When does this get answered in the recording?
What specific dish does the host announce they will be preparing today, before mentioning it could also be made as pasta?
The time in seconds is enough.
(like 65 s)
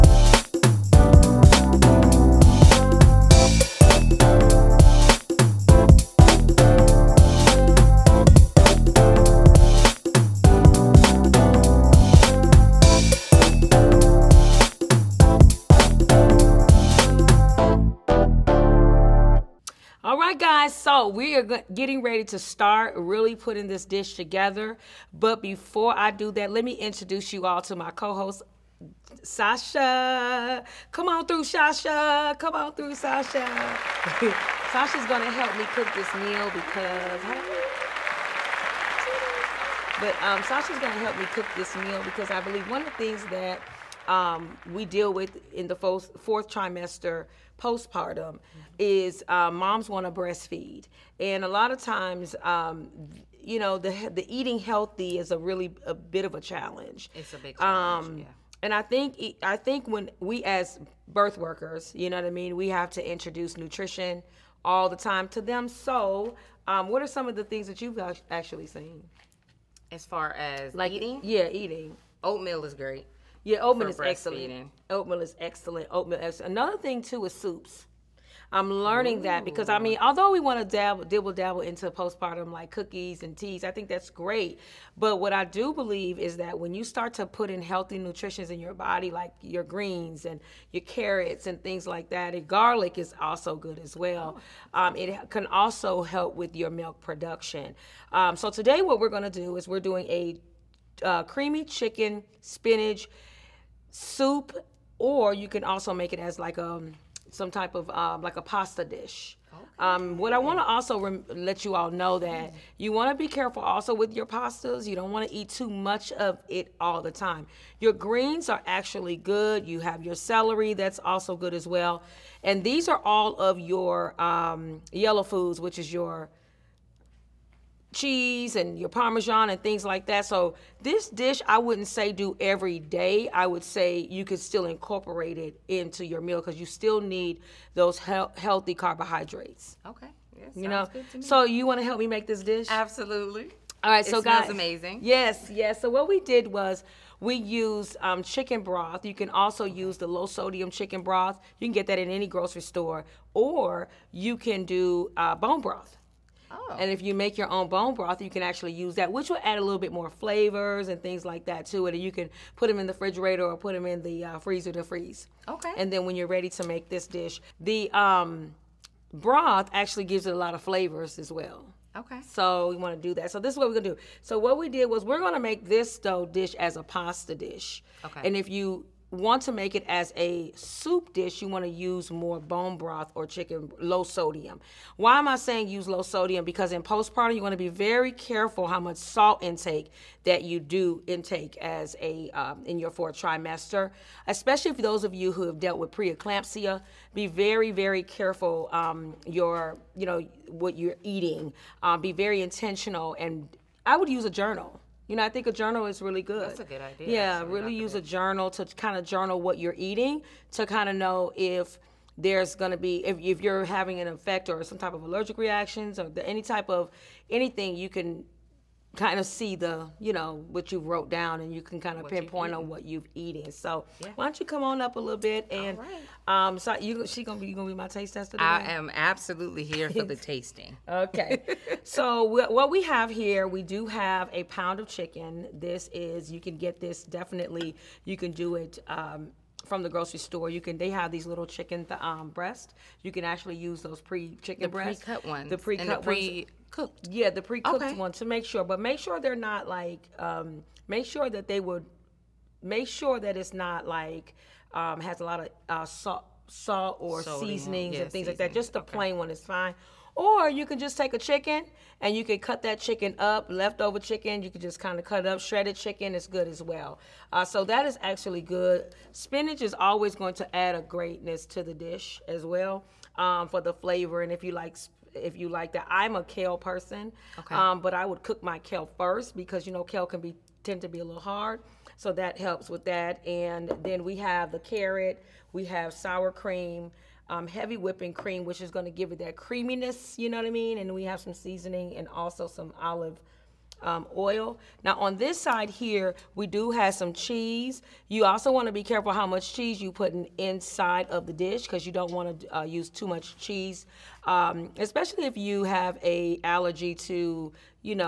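101 s.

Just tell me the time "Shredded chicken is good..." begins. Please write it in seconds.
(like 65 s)
265 s.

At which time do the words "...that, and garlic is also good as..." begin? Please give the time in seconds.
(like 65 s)
92 s.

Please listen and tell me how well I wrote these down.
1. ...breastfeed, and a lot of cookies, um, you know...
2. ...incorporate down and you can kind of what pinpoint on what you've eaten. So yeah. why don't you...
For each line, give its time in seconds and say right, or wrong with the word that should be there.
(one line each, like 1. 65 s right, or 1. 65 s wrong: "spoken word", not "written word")
1. 50 s wrong: "times", not "cookies"
2. 220 s wrong: "wrote", not "incorporate".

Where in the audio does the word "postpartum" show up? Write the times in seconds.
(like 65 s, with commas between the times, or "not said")
47 s, 81 s, 186 s.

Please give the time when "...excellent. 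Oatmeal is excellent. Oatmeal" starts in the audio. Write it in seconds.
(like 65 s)
74 s.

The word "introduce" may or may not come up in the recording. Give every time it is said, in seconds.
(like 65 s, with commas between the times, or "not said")
26 s, 63 s.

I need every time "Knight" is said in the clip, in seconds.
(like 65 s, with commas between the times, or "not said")
not said.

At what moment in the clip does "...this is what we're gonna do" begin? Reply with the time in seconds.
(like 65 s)
173 s.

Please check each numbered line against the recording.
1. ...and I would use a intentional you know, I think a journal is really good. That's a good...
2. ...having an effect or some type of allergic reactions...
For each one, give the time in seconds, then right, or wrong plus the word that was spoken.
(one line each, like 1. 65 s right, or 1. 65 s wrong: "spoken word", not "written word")
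1. 203 s wrong: "journal", not "intentional"
2. 213 s right.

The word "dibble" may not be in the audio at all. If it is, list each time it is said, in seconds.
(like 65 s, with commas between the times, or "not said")
81 s.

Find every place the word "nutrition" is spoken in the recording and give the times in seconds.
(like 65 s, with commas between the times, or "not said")
63 s, 87 s.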